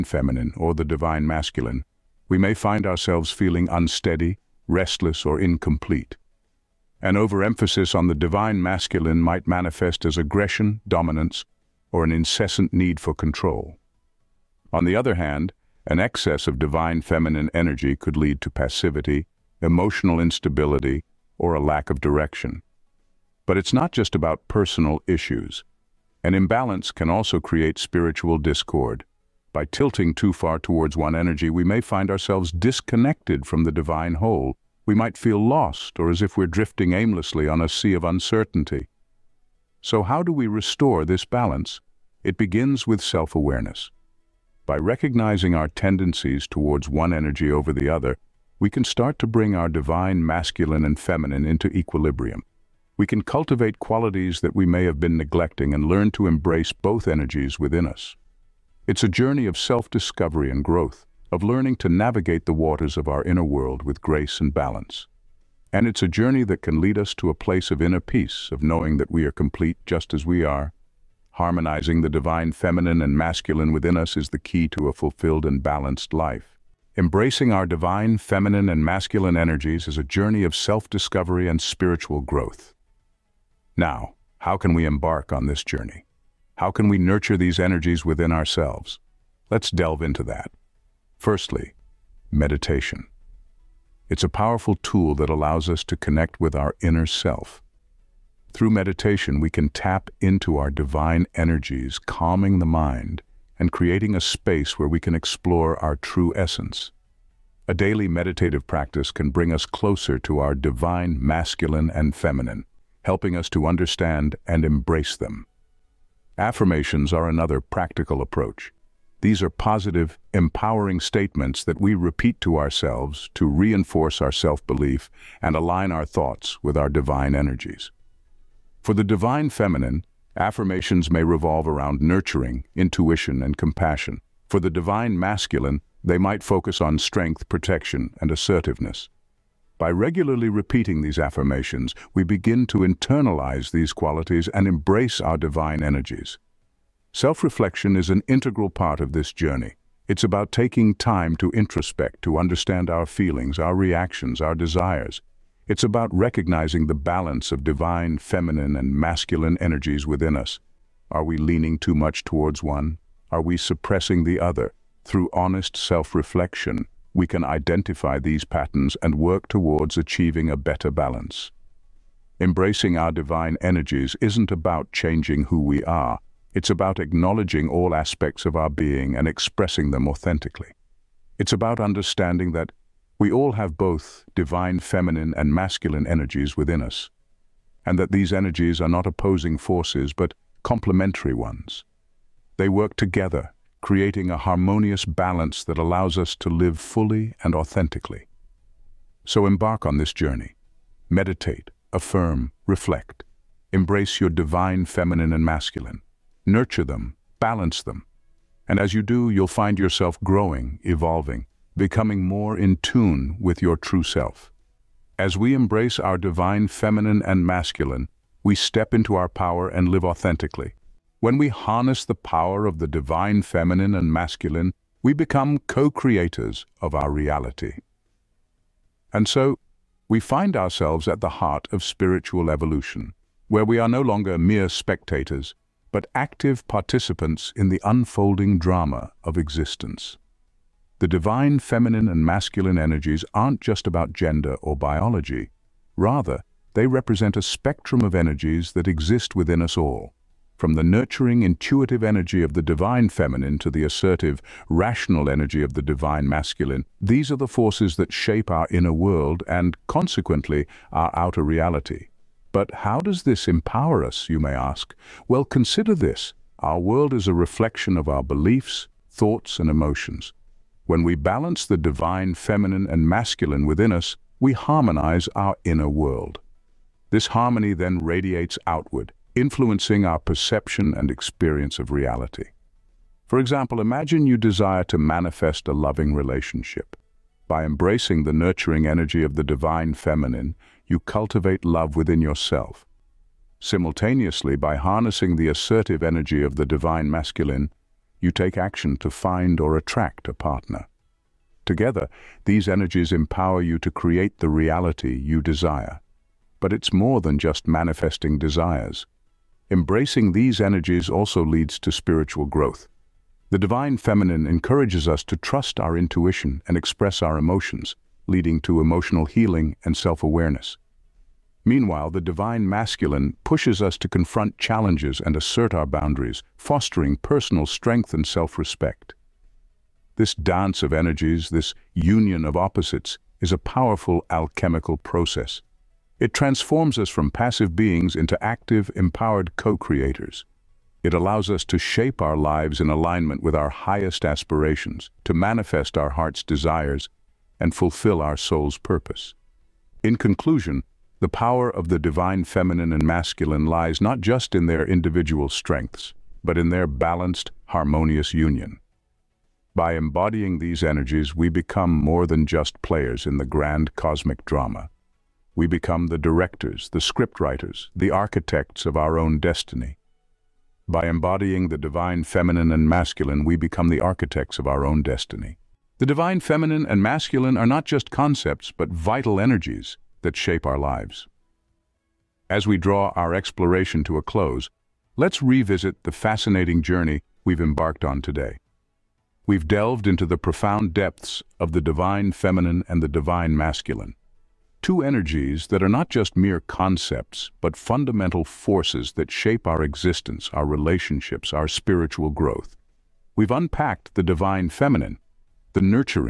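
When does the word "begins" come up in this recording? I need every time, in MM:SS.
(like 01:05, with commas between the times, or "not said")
00:42, 02:22.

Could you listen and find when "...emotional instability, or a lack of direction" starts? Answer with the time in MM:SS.
00:19.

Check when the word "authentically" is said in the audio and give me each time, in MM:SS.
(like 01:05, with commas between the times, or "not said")
03:00, 03:17, 03:40.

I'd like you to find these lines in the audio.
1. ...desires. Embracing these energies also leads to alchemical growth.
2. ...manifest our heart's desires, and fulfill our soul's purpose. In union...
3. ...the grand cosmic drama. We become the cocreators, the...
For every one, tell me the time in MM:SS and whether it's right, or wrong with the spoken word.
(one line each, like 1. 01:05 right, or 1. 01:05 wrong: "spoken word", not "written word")
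1. 05:08 wrong: "spiritual", not "alchemical"
2. 05:45 wrong: "conclusion", not "union"
3. 06:03 wrong: "directors", not "cocreators".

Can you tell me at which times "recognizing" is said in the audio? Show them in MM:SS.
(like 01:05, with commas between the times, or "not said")
00:44, 02:36.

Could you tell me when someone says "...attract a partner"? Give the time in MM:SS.
04:59.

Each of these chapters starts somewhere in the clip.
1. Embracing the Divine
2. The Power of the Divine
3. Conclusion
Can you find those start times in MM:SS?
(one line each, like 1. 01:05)
1. 01:15
2. 03:40
3. 06:14.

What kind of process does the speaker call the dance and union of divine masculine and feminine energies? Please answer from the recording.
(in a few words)
Alchemical process.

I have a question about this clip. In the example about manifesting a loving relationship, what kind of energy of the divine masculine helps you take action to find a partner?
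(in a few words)
Assertive energy.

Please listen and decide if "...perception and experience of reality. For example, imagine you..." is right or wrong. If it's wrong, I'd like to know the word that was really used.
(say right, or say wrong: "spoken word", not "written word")
right.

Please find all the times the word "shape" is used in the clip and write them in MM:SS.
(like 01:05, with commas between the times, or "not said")
04:18, 05:41, 06:20, 06:39.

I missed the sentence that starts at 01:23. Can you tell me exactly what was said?
Now, how can we embark on this journey?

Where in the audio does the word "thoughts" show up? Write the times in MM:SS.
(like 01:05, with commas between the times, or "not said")
02:06, 04:29.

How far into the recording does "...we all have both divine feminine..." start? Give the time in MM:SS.
03:03.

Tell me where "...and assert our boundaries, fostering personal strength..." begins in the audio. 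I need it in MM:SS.
05:25.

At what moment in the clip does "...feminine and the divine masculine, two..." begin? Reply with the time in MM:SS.
06:32.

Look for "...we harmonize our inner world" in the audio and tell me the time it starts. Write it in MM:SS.
04:34.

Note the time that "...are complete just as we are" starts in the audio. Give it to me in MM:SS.
01:09.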